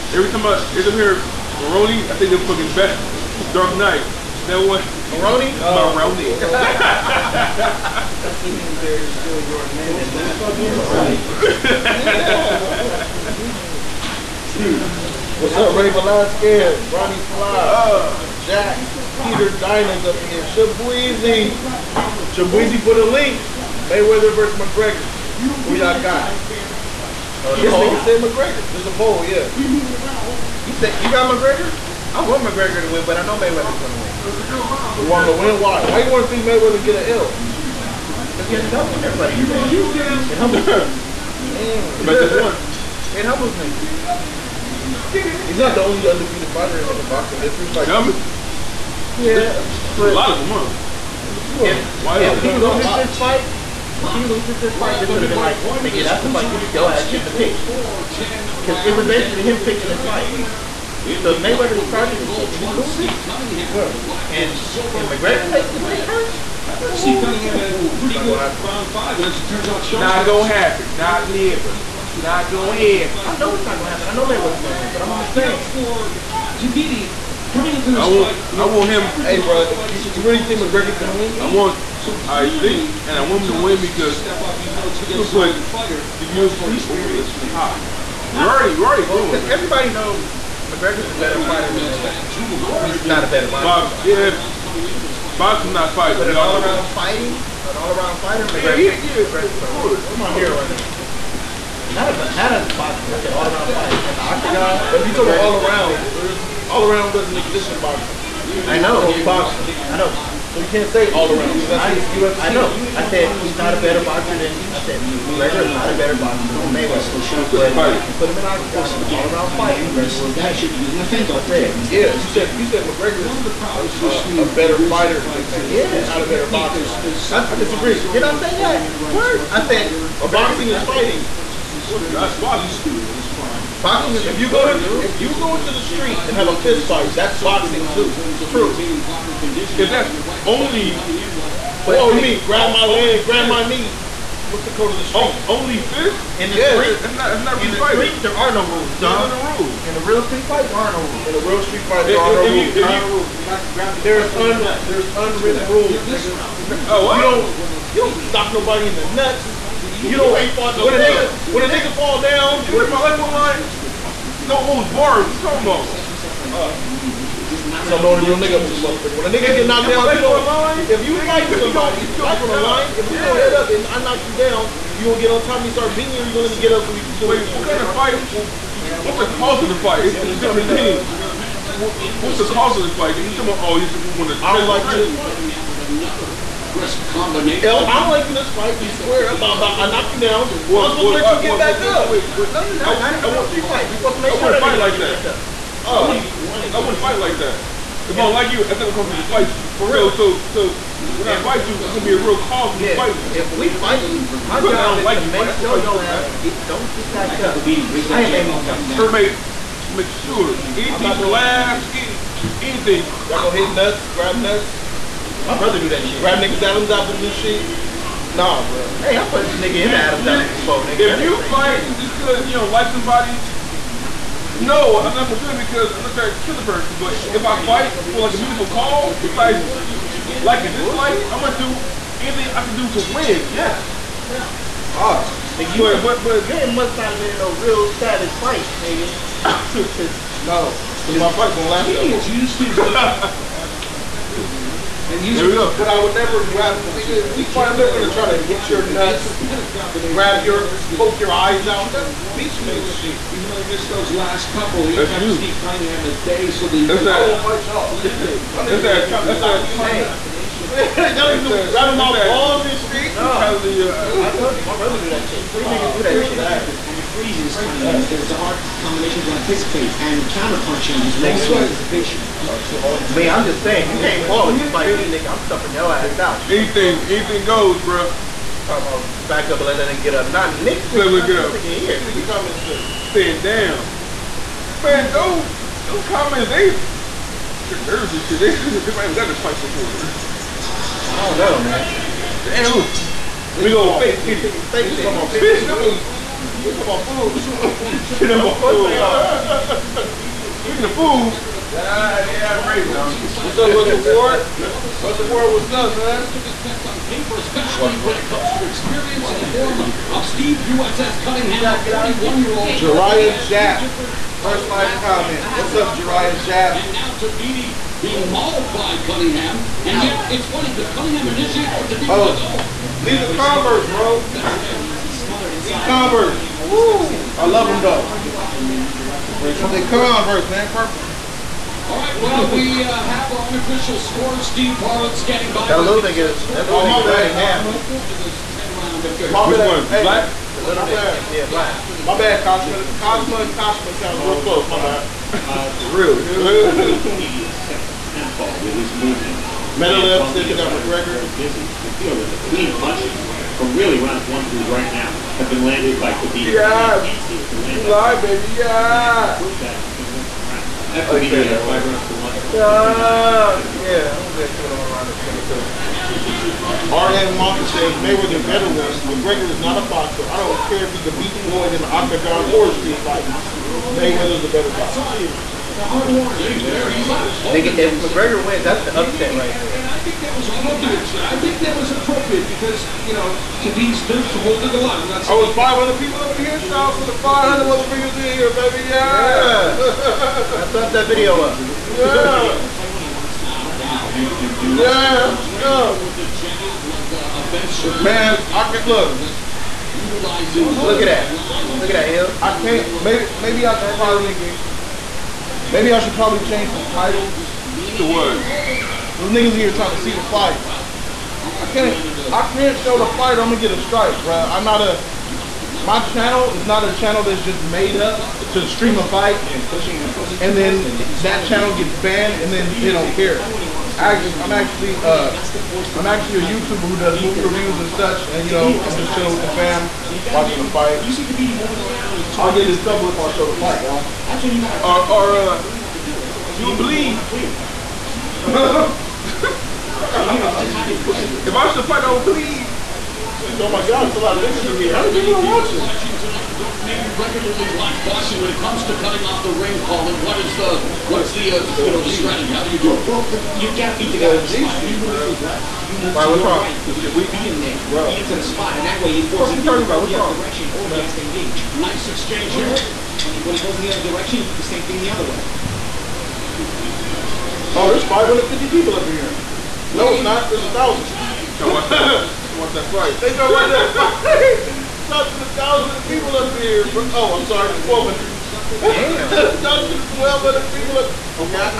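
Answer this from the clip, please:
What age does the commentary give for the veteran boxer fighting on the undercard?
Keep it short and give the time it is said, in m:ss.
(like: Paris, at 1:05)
41, at 5:11.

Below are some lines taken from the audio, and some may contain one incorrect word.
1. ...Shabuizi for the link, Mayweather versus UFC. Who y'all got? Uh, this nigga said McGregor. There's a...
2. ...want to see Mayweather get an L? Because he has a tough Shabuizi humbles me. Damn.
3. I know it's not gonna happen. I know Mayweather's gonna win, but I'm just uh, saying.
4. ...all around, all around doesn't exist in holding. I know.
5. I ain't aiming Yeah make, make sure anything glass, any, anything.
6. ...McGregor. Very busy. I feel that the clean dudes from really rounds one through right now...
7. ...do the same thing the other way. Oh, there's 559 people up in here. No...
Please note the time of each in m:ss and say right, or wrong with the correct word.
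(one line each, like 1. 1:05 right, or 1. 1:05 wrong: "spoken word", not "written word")
1. 0:22 wrong: "McGregor", not "UFC"
2. 0:36 wrong: "Everybody", not "Shabuizi"
3. 1:13 right
4. 1:45 wrong: "boxing", not "holding"
5. 3:27 wrong: "For", not "Yeah"
6. 5:50 wrong: "punches", not "dudes"
7. 7:44 wrong: "550", not "559".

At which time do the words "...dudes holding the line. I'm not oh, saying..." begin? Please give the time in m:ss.
6:24.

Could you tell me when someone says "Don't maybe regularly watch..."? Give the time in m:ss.
7:26.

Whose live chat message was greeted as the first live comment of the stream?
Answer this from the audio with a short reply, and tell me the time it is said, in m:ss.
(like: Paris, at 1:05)
Jariah Jack, at 5:12.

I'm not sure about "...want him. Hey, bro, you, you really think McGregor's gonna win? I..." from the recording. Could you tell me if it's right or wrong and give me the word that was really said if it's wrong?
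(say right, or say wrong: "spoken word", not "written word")
right.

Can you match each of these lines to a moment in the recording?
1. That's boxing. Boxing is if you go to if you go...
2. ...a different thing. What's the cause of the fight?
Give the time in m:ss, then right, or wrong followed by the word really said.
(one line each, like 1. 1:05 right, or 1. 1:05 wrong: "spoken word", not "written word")
1. 2:12 right
2. 3:00 right.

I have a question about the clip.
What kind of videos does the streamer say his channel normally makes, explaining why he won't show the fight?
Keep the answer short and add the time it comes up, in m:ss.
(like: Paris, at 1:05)
movie reviews, at 7:07.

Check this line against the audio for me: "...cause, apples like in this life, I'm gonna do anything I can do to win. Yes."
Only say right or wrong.
wrong.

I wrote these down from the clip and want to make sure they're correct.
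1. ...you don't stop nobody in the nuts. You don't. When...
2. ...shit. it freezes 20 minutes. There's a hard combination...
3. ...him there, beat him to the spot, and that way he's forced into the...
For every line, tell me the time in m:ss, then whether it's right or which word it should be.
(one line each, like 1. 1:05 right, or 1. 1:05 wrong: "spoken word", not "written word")
1. 2:37 right
2. 4:26 right
3. 7:37 right.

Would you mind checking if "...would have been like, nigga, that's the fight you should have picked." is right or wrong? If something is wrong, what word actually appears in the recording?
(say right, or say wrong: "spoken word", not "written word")
right.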